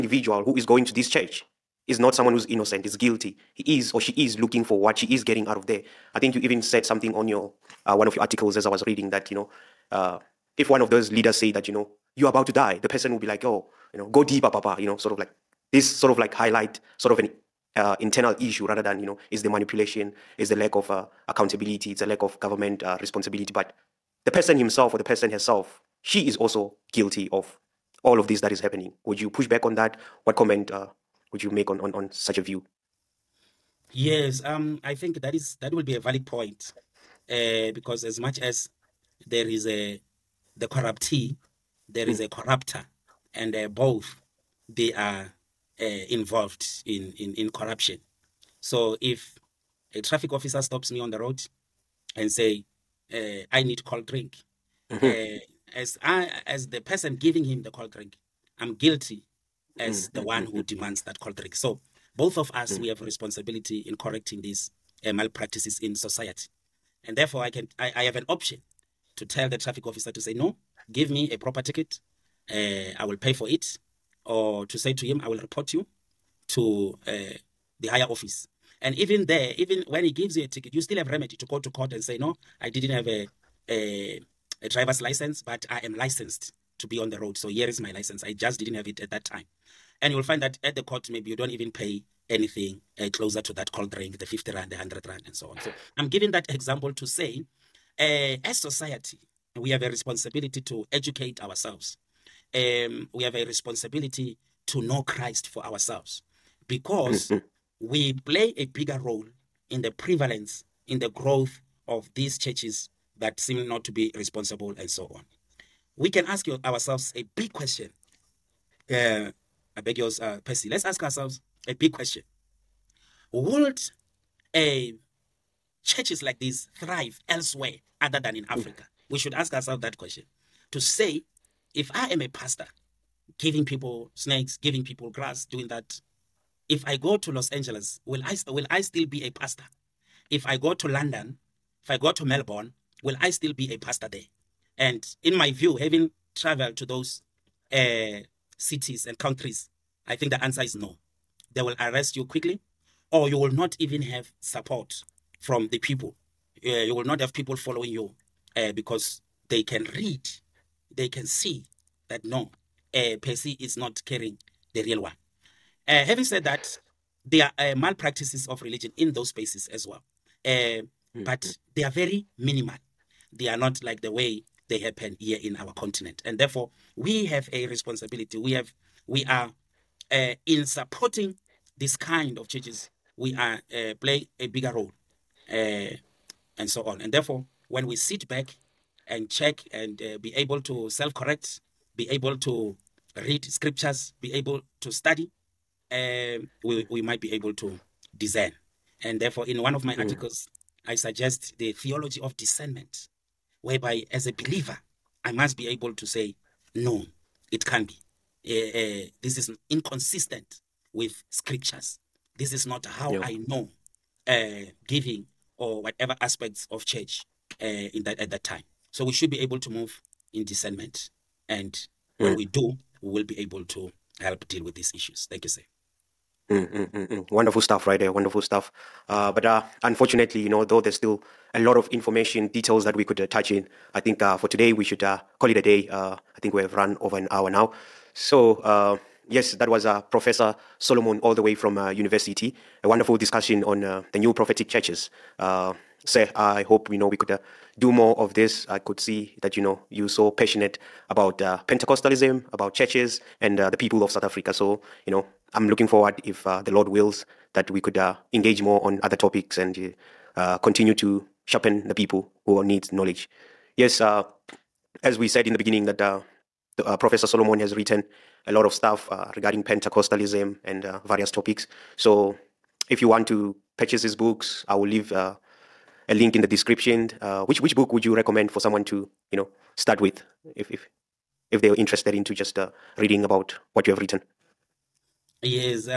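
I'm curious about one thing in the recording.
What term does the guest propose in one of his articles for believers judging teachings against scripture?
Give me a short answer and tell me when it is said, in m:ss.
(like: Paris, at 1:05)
theology of discernment, at 3:21.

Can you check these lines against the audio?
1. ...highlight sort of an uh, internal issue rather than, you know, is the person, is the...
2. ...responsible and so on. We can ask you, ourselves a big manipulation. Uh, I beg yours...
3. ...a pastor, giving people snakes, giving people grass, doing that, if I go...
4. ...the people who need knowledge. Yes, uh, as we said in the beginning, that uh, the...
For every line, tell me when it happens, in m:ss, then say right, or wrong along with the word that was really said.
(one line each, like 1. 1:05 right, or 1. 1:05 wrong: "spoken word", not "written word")
1. 0:16 wrong: "manipulation", not "person"
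2. 1:54 wrong: "question", not "manipulation"
3. 2:12 right
4. 4:21 right.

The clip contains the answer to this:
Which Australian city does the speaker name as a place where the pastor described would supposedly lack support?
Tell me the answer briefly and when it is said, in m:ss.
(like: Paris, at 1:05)
Melbourne, at 2:22.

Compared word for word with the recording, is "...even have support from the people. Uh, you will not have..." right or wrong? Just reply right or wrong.
right.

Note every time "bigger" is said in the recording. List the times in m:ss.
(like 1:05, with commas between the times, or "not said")
1:48, 3:04.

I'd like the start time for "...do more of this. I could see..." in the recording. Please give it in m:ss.
4:07.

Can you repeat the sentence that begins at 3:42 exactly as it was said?
we do, we will be able to help deal with these issues.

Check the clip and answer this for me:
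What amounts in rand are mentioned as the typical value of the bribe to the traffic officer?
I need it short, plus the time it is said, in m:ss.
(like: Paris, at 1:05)
50 rand, 100 rand, at 1:34.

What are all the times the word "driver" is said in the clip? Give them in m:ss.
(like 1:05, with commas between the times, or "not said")
1:24.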